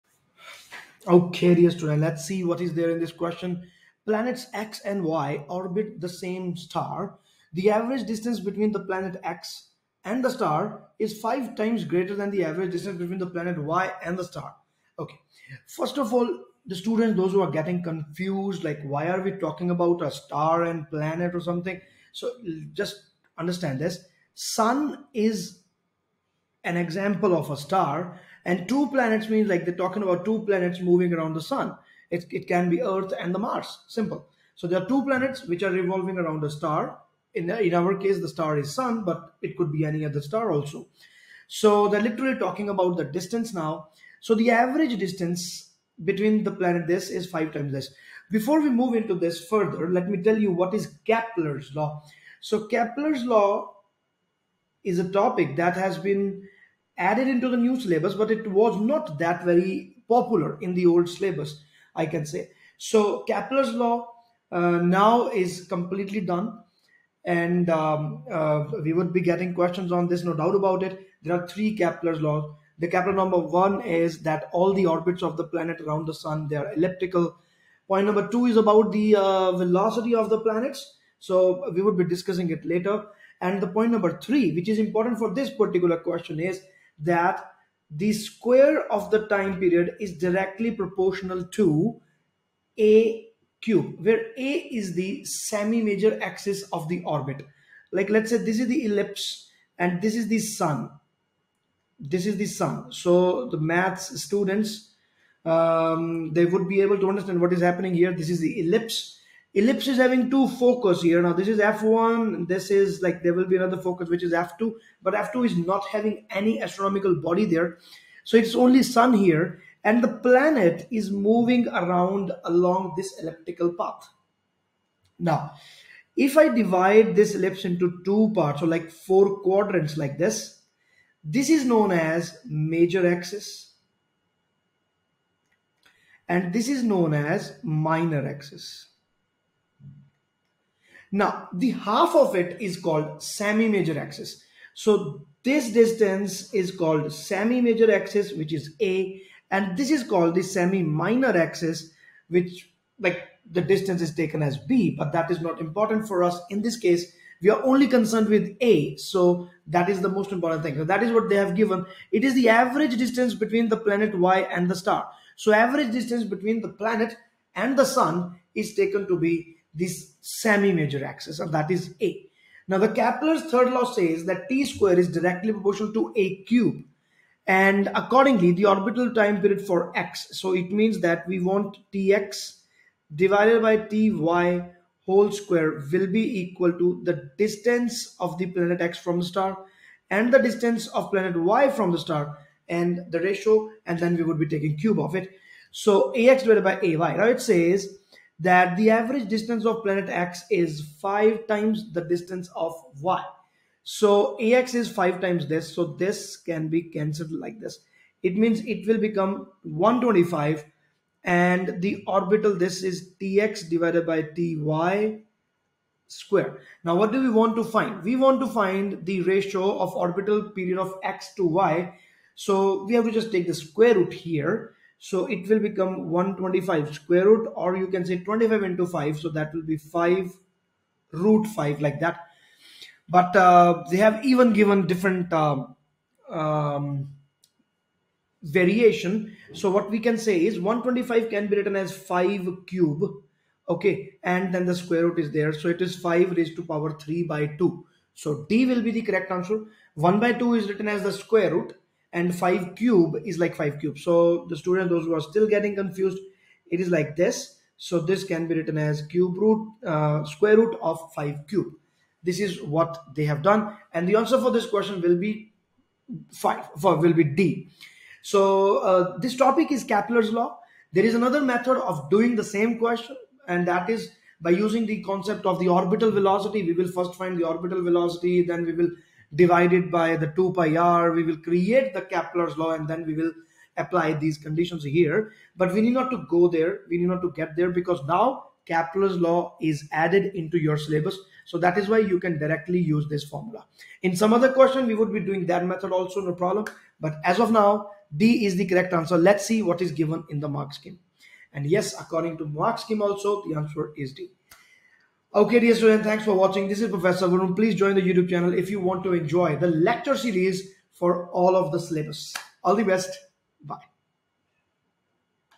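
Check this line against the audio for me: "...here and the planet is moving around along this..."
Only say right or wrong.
right.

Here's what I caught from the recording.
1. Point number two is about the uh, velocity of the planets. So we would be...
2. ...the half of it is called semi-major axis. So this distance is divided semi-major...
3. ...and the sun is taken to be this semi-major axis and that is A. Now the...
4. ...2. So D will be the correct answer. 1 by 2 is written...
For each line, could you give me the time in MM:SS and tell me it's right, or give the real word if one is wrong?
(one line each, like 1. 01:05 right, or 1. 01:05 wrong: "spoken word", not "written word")
1. 01:17 right
2. 02:21 wrong: "called", not "divided"
3. 02:47 right
4. 04:07 right.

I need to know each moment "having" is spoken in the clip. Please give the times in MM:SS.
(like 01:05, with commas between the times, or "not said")
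01:49, 01:55.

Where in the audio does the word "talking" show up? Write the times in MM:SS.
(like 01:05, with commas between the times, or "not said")
00:19, 00:29, 00:42.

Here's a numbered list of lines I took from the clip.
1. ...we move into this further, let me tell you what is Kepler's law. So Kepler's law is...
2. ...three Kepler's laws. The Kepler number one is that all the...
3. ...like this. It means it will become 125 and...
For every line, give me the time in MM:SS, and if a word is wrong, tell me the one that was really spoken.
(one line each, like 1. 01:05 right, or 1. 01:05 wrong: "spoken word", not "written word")
1. 00:48 right
2. 01:11 right
3. 03:27 right.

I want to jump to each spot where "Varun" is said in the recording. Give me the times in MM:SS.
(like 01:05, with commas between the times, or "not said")
05:07.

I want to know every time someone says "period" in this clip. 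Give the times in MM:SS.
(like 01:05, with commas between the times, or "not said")
01:29, 02:59, 03:40.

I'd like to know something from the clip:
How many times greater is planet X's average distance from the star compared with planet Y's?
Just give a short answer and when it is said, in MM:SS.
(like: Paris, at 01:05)
5, at 00:11.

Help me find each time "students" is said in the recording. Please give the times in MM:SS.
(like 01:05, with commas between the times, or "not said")
00:01, 00:16, 01:44, 04:14, 05:05.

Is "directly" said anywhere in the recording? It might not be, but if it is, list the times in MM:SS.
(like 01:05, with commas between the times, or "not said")
01:30, 02:55, 04:52.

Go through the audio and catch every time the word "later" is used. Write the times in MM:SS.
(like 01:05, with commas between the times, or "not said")
01:22.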